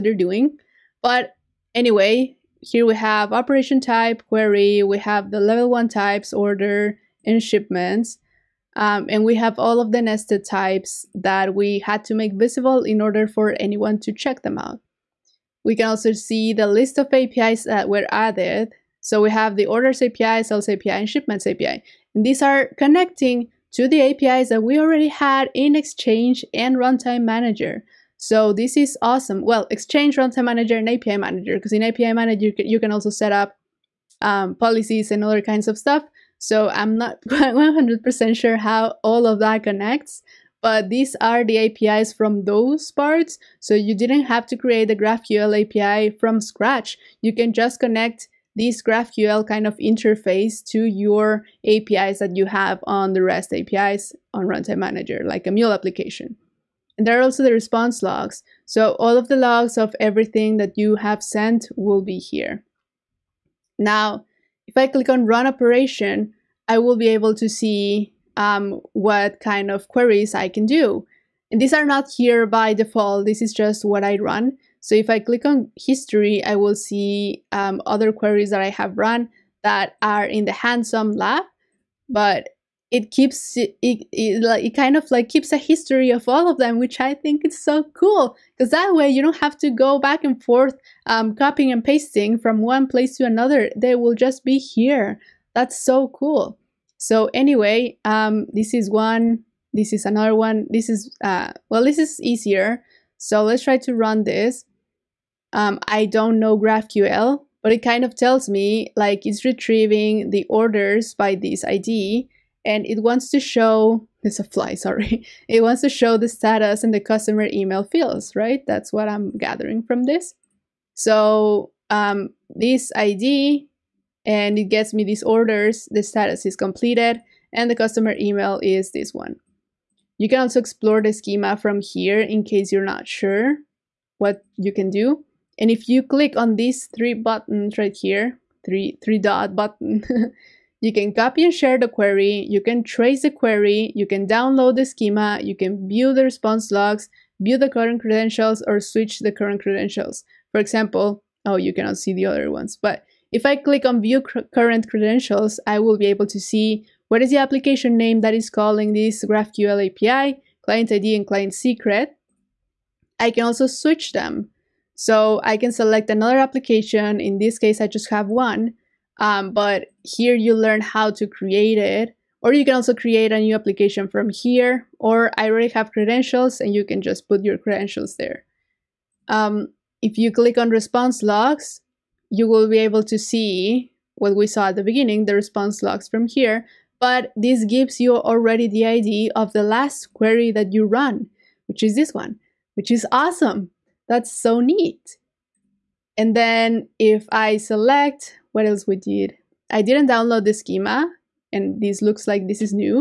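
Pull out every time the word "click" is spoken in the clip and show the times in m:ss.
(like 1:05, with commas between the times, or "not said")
1:04, 1:15, 2:16, 2:33, 3:00.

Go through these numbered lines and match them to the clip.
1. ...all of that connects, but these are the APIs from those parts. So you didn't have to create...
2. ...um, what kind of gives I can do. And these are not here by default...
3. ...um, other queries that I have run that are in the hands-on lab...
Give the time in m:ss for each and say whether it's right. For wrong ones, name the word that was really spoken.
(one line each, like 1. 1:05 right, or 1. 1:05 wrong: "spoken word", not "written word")
1. 0:39 right
2. 1:08 wrong: "queries", not "gives"
3. 1:17 right.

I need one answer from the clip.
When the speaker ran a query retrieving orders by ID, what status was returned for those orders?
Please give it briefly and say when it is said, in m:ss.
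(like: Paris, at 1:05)
Completed, at 2:06.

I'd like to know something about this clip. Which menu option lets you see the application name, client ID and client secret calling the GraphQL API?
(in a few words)
View current credentials.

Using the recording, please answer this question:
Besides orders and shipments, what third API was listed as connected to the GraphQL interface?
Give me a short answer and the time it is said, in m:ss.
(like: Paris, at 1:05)
Sales API, at 0:20.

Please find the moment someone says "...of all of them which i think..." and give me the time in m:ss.
1:26.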